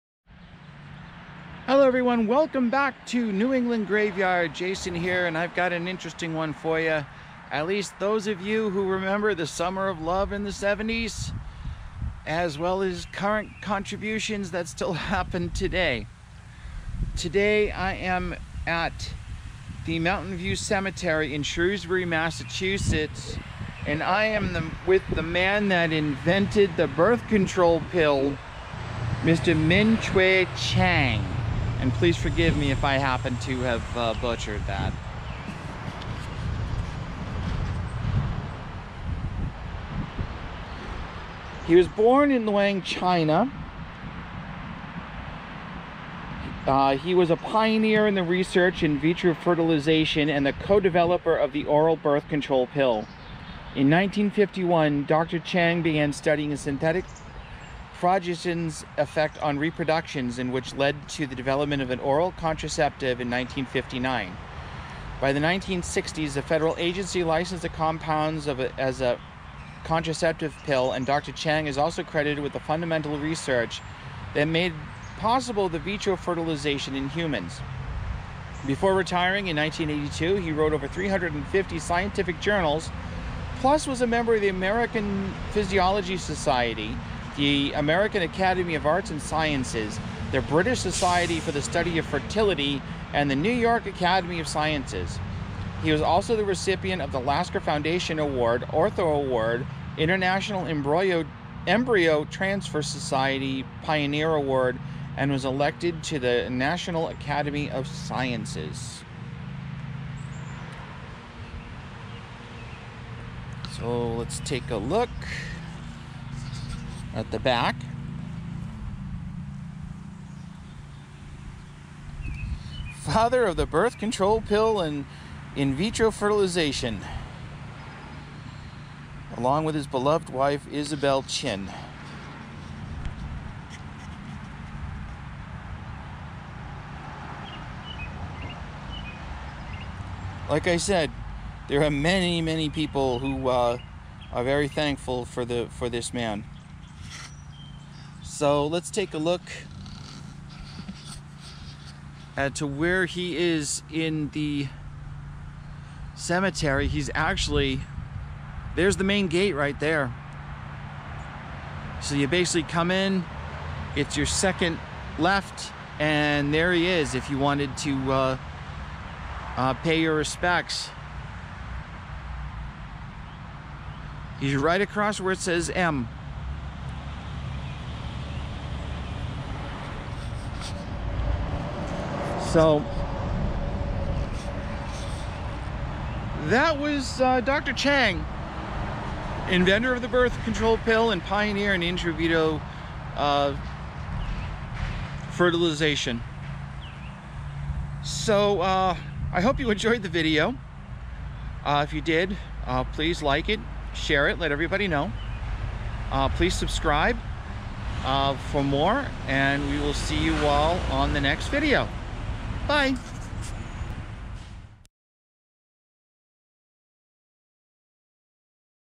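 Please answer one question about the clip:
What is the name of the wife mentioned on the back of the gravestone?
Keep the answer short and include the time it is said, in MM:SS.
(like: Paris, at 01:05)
Isabel Chin, at 02:10.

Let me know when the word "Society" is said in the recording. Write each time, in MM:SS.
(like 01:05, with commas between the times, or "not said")
01:26, 01:30, 01:42.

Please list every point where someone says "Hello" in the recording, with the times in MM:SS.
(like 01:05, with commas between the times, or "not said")
00:01.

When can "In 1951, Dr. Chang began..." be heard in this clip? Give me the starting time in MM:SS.
00:53.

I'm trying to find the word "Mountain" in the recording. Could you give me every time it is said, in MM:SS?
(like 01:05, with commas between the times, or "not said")
00:19.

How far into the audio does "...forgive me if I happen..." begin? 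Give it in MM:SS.
00:32.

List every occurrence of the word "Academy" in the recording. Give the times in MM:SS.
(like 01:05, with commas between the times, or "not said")
01:28, 01:33, 01:47.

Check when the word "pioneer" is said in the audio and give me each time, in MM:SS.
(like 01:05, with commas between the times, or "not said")
00:47, 01:43, 03:11.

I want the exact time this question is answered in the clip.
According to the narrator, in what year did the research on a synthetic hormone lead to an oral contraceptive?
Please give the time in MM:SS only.
01:03.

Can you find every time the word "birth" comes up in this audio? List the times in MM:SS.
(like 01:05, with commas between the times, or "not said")
00:26, 00:51, 02:03, 03:10.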